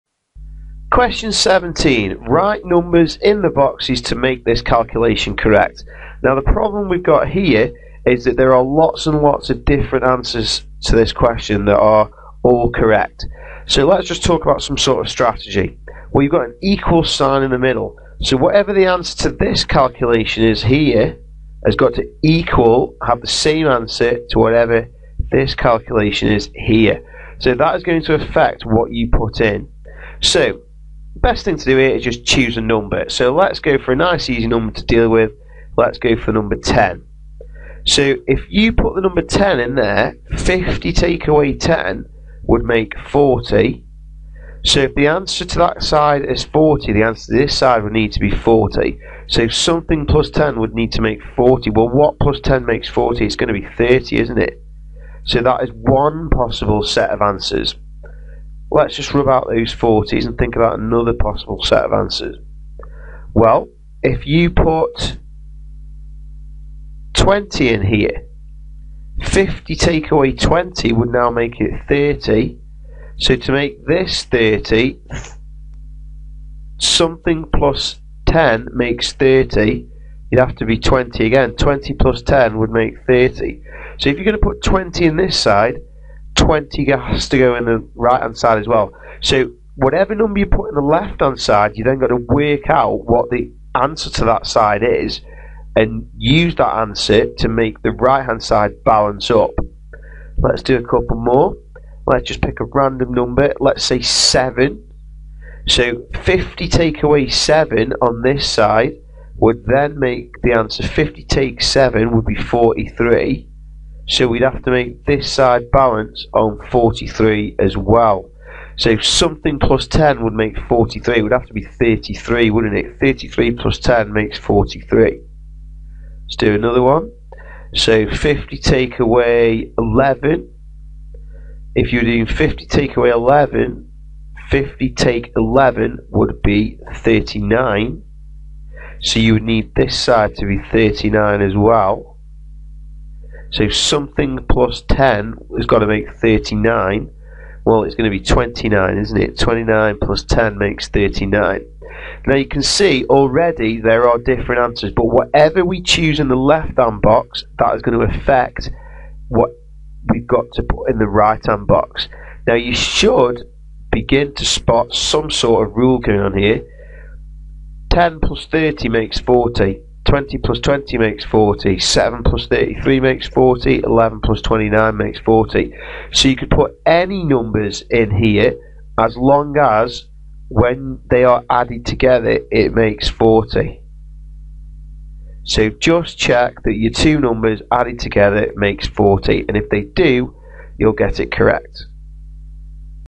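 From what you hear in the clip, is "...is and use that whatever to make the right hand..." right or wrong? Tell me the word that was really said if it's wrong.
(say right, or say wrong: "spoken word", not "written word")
wrong: "answer", not "whatever".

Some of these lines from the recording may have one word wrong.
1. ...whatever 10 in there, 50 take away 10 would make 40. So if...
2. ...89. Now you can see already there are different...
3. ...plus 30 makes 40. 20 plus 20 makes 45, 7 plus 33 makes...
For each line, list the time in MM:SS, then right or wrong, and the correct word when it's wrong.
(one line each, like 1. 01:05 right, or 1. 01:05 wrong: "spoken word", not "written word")
1. 00:39 wrong: "number", not "whatever"
2. 02:30 wrong: "39", not "89"
3. 02:48 wrong: "40", not "45".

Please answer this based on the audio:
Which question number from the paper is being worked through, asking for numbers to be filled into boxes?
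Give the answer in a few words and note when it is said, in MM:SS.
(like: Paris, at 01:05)
17, at 00:01.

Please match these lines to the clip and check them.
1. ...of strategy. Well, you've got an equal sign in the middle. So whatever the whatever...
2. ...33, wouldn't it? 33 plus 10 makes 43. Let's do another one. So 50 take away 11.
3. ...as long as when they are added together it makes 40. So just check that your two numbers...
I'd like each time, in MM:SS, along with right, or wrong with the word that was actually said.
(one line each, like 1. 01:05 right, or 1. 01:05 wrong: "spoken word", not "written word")
1. 00:15 wrong: "answer", not "whatever"
2. 02:01 right
3. 02:58 right.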